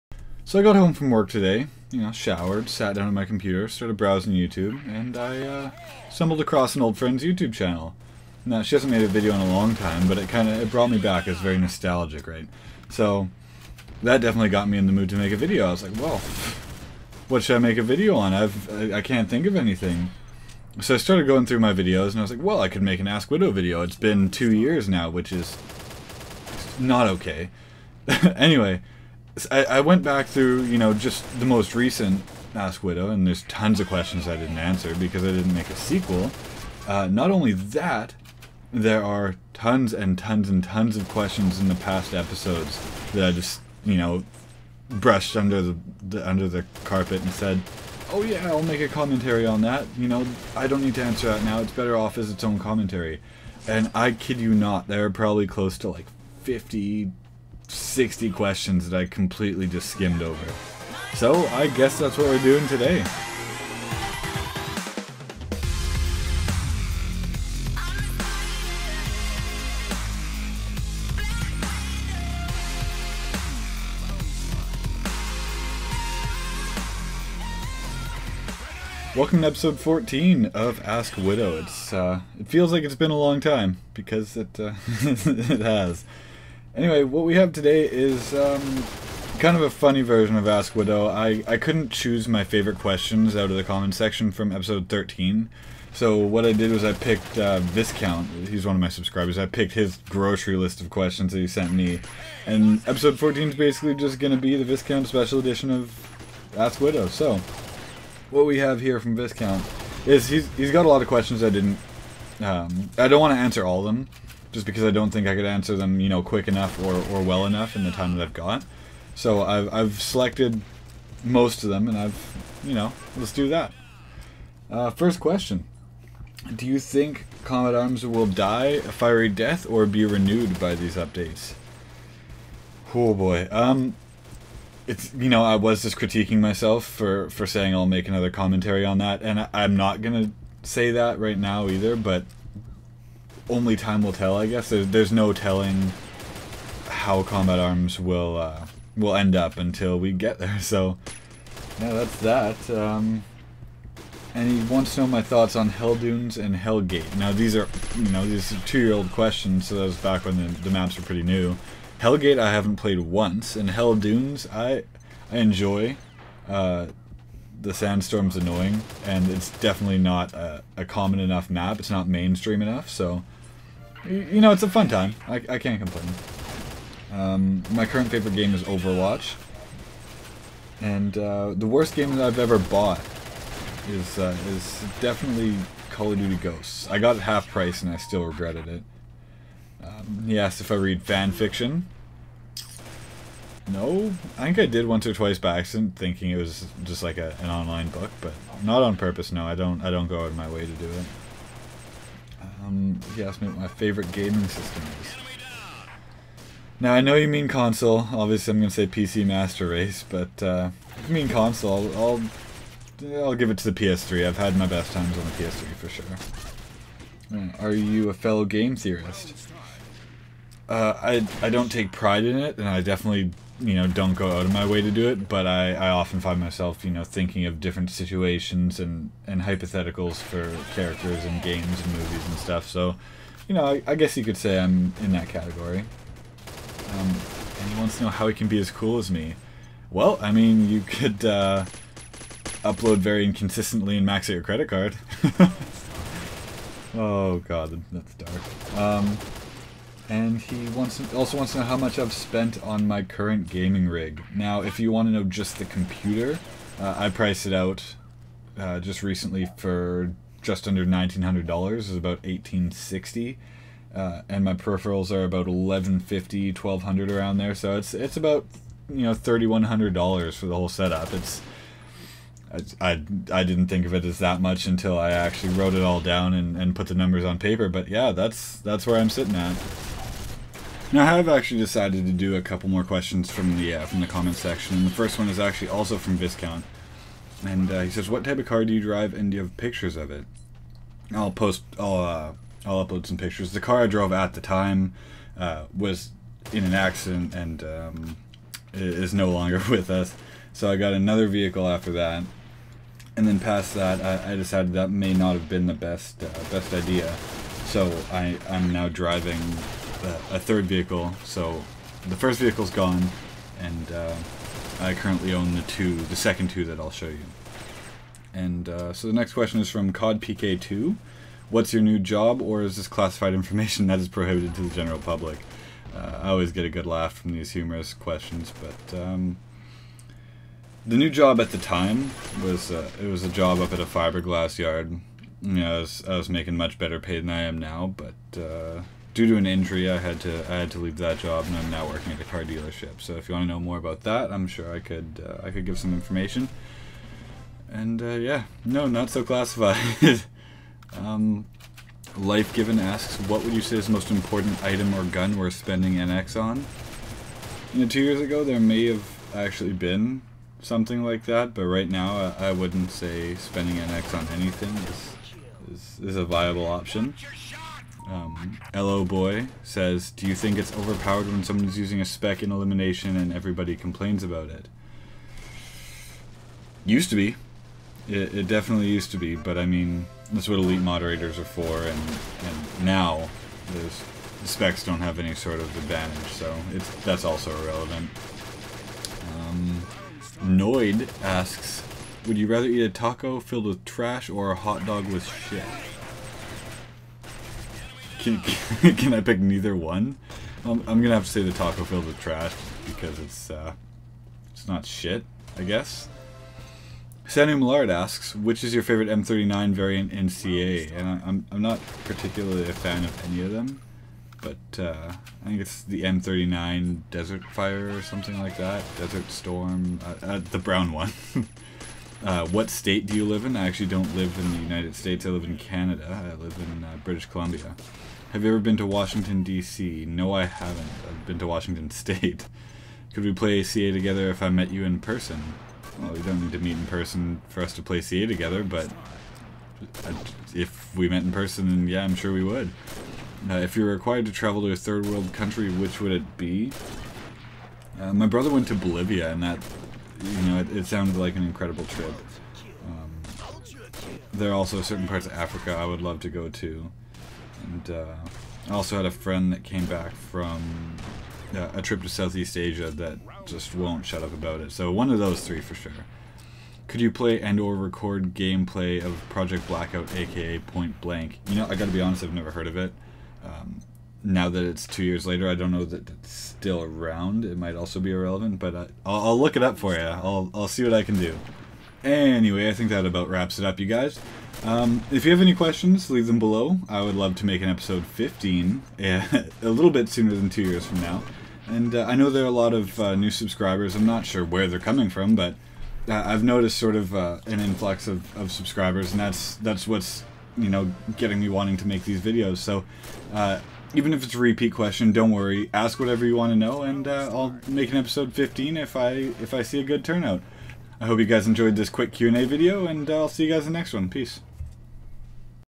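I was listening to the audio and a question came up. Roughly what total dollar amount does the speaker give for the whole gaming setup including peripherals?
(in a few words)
$3100.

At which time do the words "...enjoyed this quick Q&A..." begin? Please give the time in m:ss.
8:31.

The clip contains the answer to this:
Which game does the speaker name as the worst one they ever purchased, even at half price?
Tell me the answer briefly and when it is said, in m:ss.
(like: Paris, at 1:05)
Call of Duty Ghosts, at 3:05.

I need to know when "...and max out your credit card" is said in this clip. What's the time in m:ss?
4:03.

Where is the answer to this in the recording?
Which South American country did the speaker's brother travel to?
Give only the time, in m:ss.
7:28.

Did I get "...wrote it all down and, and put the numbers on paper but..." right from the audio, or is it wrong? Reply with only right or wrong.
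right.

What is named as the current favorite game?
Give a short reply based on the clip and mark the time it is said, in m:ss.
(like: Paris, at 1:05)
Overwatch, at 2:58.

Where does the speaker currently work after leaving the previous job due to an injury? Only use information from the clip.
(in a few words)
a car dealership.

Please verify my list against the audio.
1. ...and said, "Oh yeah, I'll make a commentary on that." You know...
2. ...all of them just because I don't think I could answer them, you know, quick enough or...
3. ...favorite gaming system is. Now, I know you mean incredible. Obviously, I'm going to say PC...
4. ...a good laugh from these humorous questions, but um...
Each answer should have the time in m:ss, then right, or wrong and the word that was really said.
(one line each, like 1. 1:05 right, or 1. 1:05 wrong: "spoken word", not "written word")
1. 0:47 right
2. 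1:53 right
3. 3:23 wrong: "console", not "incredible"
4. 5:26 right.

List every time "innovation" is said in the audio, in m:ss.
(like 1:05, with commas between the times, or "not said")
not said.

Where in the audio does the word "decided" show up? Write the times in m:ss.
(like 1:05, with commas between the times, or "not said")
4:41, 5:04.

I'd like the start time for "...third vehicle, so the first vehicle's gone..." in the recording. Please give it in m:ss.
5:10.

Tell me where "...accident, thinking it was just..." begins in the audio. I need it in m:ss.
3:15.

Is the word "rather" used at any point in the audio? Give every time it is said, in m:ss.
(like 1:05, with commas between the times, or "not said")
6:32.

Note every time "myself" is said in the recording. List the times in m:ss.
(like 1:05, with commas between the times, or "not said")
2:16, 3:46.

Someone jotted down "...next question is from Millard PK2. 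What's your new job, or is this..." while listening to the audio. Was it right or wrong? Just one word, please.
wrong.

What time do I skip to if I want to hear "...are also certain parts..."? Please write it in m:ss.
7:34.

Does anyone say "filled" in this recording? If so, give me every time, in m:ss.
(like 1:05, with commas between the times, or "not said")
6:33, 6:41.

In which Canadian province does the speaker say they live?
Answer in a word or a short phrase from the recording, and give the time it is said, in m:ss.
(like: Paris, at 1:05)
British Columbia, at 7:07.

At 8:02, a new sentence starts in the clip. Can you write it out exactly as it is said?
Anyway, I think that about wraps it up, you guys.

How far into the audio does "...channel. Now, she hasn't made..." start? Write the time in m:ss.
0:07.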